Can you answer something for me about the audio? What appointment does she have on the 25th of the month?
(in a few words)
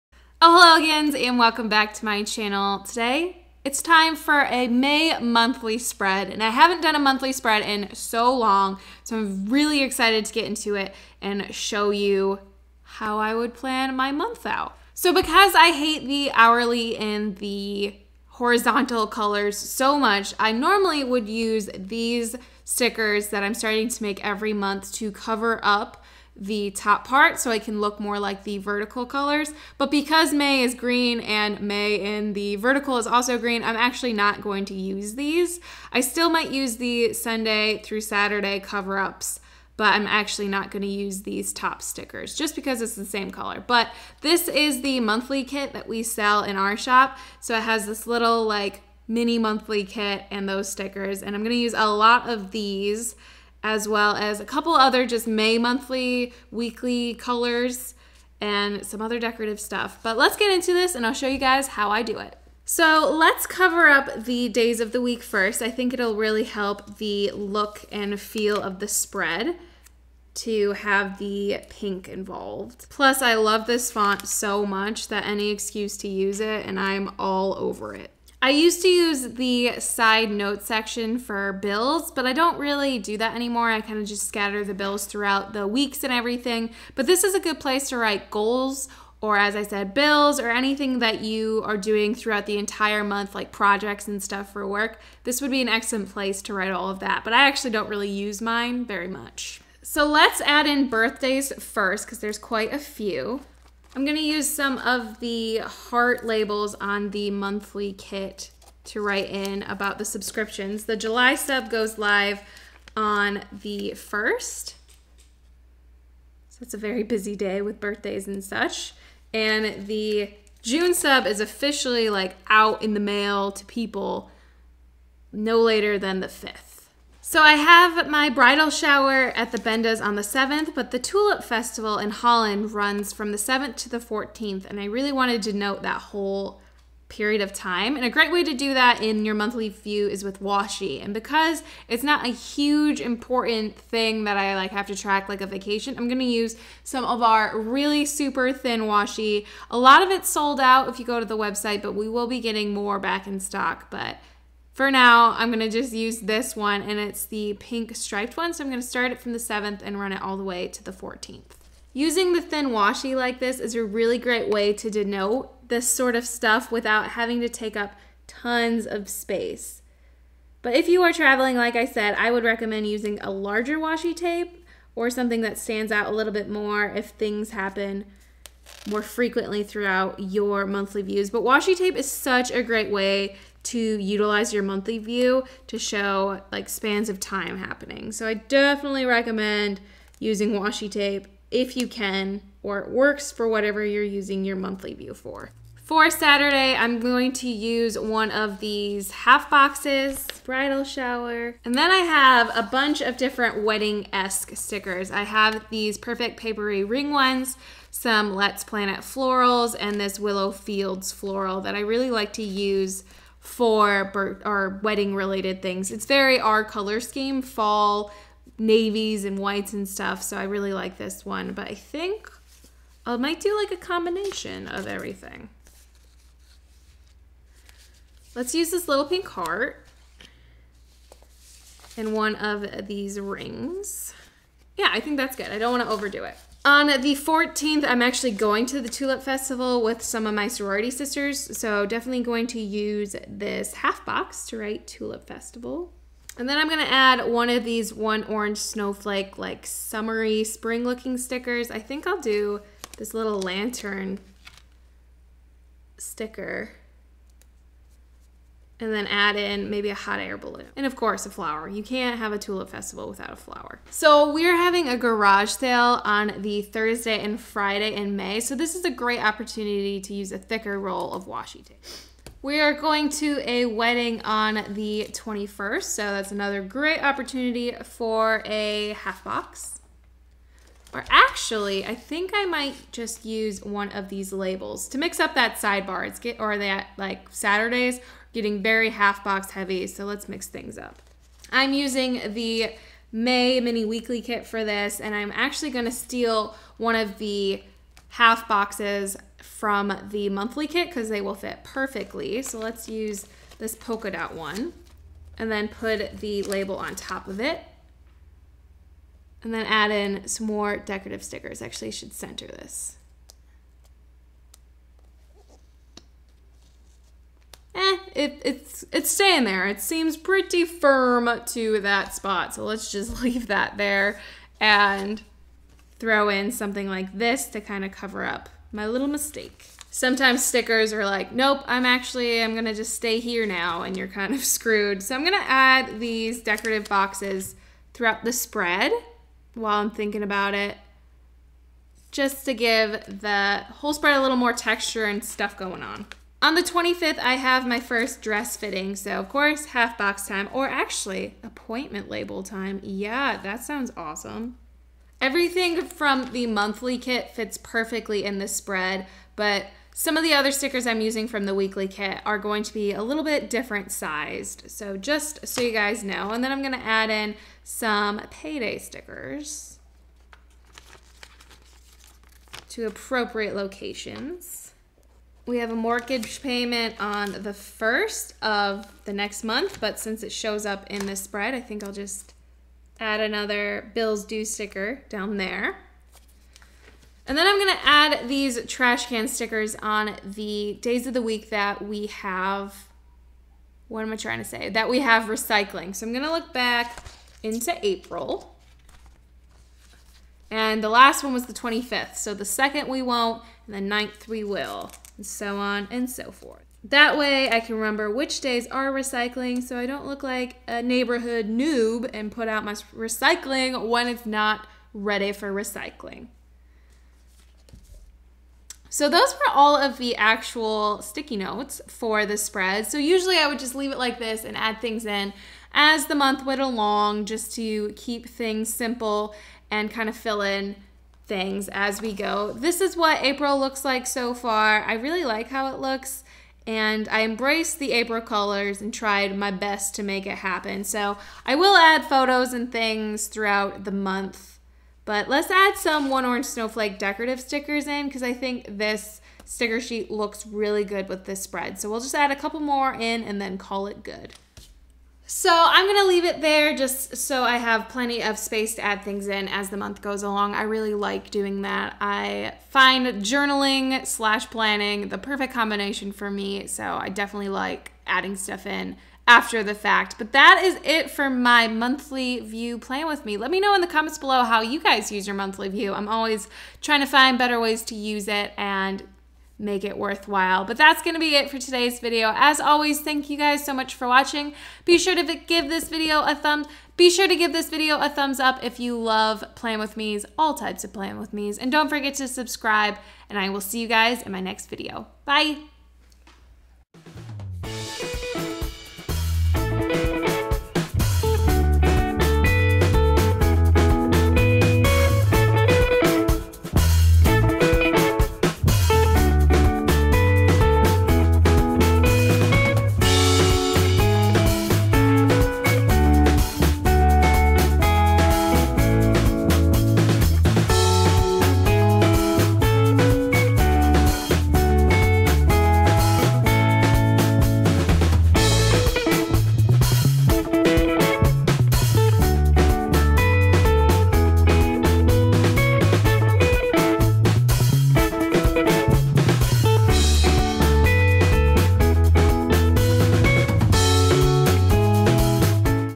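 first dress fitting.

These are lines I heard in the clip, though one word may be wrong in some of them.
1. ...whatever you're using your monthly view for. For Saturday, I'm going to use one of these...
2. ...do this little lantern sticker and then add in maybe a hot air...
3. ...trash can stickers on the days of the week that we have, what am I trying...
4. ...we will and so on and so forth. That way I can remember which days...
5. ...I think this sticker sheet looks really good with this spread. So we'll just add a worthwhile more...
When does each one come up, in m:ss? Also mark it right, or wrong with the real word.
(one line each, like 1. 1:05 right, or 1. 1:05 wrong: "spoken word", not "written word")
1. 3:13 right
2. 4:12 right
3. 6:28 right
4. 6:44 right
5. 7:28 wrong: "couple", not "worthwhile".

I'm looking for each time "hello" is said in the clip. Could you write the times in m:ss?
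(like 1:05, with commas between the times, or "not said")
0:00.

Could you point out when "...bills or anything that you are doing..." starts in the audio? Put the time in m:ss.
1:29.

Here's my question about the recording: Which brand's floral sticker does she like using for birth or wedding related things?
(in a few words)
Willowfields.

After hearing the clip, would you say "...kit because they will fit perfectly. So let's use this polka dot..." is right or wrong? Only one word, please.
right.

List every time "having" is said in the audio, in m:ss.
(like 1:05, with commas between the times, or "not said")
2:47, 4:24.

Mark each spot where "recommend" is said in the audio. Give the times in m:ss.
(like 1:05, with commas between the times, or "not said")
2:52, 3:09.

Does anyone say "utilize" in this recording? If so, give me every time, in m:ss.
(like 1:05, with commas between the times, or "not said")
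3:03.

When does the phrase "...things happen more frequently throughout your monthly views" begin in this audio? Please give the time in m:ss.
2:57.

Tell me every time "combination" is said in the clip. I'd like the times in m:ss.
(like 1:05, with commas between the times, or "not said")
3:43, 7:45.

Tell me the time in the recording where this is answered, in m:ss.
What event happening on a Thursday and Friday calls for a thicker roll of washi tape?
4:24.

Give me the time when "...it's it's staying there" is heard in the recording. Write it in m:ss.
5:18.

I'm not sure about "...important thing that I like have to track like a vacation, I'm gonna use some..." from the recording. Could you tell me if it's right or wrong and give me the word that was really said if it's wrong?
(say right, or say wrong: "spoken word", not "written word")
right.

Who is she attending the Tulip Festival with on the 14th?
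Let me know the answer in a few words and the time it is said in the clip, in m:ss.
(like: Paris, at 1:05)
sorority sisters, at 4:00.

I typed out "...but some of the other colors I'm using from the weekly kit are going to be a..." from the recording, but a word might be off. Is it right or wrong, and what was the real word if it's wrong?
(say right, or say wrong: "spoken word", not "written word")
wrong: "stickers", not "colors".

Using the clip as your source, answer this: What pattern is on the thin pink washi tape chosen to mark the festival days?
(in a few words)
striped.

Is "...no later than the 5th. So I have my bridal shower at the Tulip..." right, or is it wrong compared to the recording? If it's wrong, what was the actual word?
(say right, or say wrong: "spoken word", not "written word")
wrong: "Bendas", not "Tulip".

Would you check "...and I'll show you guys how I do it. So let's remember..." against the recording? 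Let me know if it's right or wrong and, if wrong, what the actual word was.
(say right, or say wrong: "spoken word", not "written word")
wrong: "cover", not "remember".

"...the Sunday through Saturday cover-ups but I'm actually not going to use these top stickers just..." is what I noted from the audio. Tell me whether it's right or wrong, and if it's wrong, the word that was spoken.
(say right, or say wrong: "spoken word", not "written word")
right.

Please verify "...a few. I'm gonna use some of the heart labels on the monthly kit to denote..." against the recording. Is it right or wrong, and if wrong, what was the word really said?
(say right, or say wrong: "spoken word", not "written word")
wrong: "write", not "denote".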